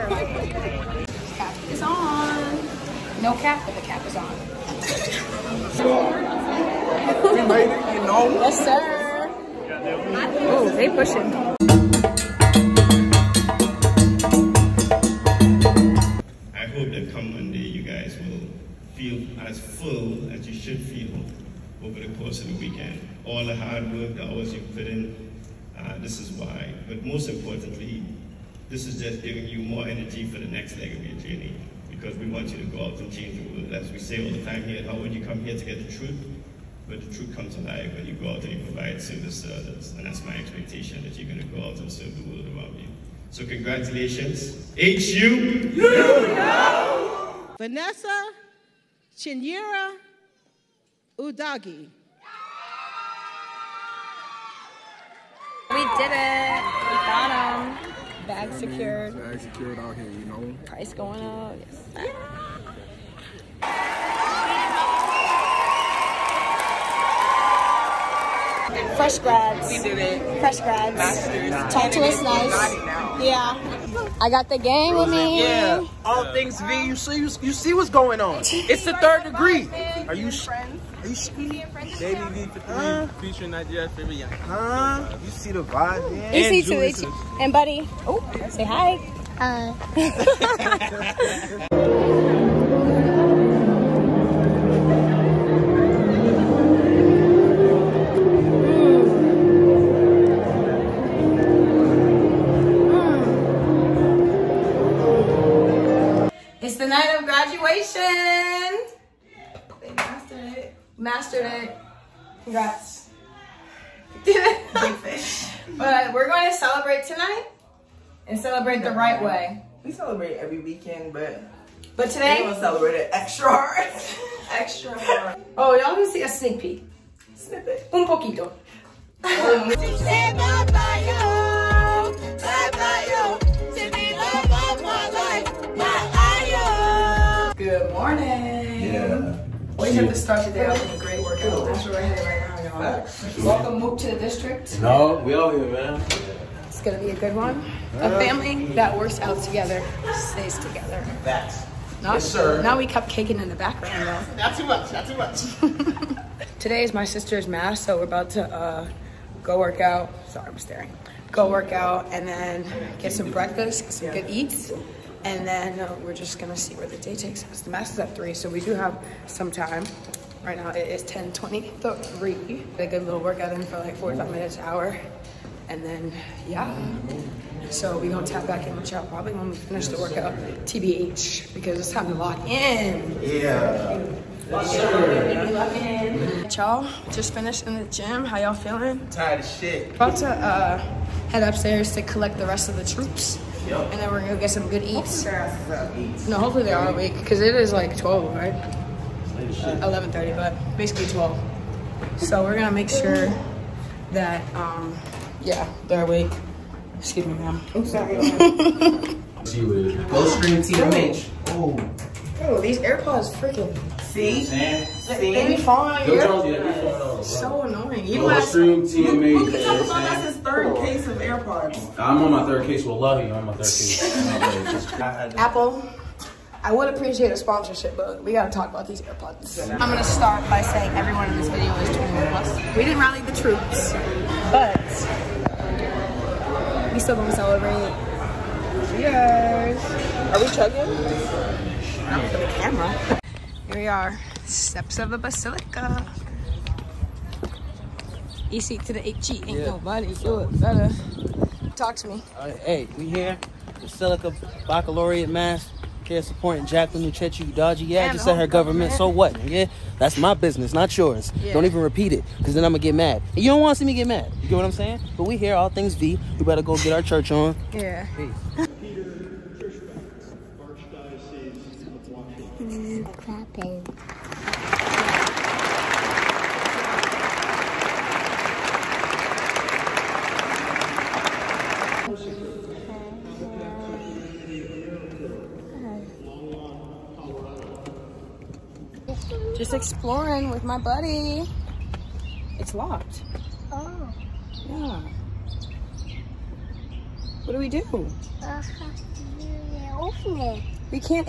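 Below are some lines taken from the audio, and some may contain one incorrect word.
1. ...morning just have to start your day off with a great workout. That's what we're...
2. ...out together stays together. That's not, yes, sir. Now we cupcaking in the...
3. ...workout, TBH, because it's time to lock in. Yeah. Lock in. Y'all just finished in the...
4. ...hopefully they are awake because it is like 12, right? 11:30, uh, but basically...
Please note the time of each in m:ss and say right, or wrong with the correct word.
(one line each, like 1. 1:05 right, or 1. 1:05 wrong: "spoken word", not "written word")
1. 2:17 right
2. 2:29 right
3. 2:59 right
4. 3:16 right.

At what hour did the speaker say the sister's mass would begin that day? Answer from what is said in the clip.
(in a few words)
3.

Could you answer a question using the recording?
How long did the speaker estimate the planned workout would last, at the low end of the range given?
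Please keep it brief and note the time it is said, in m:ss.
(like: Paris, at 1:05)
45 minutes, at 2:53.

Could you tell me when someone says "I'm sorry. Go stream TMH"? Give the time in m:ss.
3:27.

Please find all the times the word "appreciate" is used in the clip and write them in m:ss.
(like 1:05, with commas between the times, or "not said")
3:46.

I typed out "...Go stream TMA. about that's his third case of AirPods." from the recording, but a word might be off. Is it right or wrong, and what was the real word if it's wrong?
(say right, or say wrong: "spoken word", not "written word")
right.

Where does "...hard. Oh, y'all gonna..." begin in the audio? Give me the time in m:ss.
2:04.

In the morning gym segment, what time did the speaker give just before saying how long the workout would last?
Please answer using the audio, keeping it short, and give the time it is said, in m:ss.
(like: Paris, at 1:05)
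10:23, at 2:51.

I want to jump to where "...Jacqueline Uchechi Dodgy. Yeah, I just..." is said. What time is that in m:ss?
4:16.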